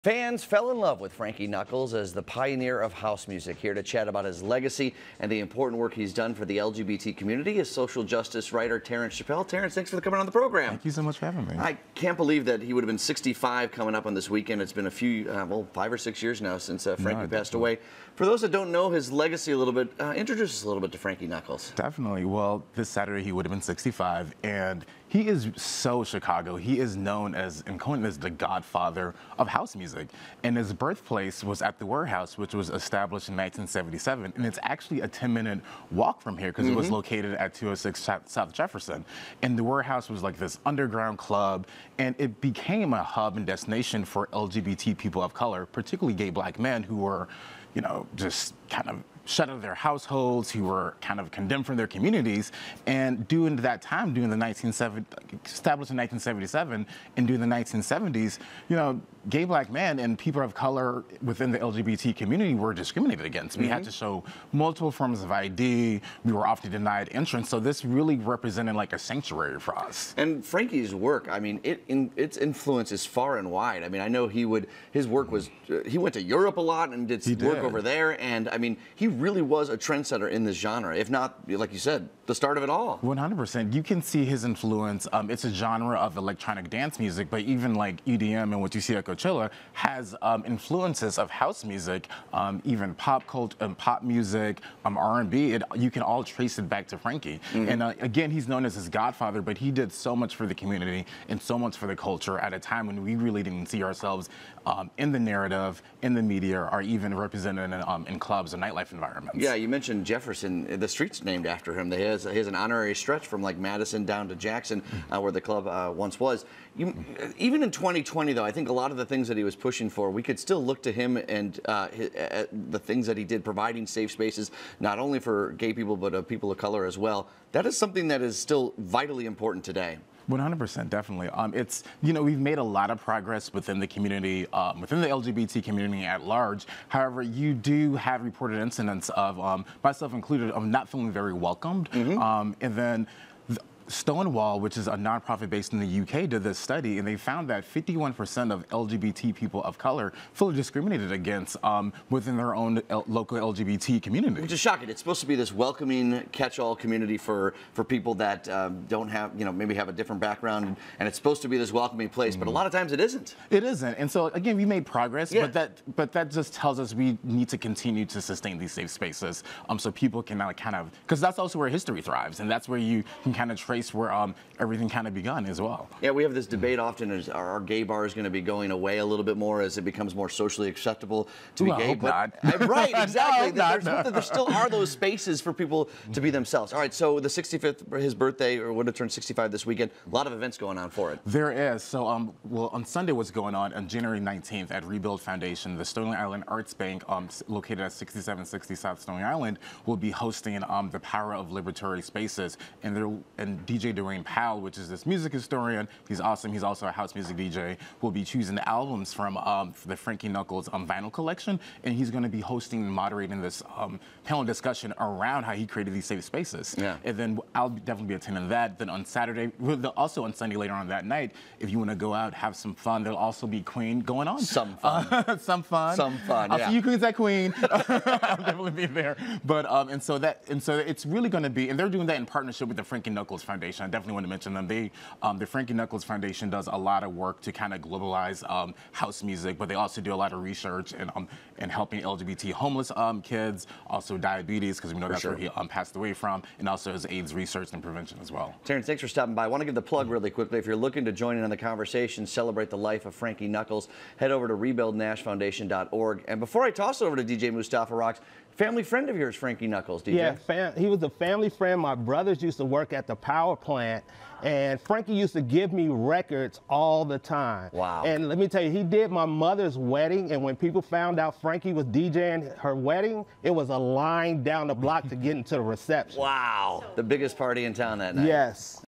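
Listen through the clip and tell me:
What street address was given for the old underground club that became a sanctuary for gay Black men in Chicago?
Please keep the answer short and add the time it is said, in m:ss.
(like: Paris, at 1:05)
206 South Jefferson, at 0:37.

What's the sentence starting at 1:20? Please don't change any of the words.
If not, like you said, the start of it all.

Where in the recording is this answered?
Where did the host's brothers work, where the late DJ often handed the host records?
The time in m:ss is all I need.
4:23.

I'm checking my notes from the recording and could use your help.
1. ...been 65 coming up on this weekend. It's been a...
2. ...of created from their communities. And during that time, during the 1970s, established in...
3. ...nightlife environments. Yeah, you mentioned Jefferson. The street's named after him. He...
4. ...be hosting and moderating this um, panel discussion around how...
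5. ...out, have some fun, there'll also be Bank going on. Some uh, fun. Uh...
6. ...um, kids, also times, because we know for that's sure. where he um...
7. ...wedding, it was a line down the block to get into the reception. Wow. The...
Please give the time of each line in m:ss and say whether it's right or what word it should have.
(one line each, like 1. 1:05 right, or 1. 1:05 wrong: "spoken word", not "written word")
1. 0:12 right
2. 0:51 wrong: "condemned", not "created"
3. 1:48 right
4. 3:32 right
5. 3:42 wrong: "Queen", not "Bank"
6. 4:02 wrong: "diabetes", not "times"
7. 4:32 right.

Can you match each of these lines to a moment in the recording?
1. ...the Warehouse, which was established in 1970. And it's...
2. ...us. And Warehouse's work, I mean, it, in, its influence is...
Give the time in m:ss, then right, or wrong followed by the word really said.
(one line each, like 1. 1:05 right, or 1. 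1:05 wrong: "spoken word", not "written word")
1. 0:31 wrong: "1977", not "1970"
2. 1:09 wrong: "Frankie", not "Warehouse".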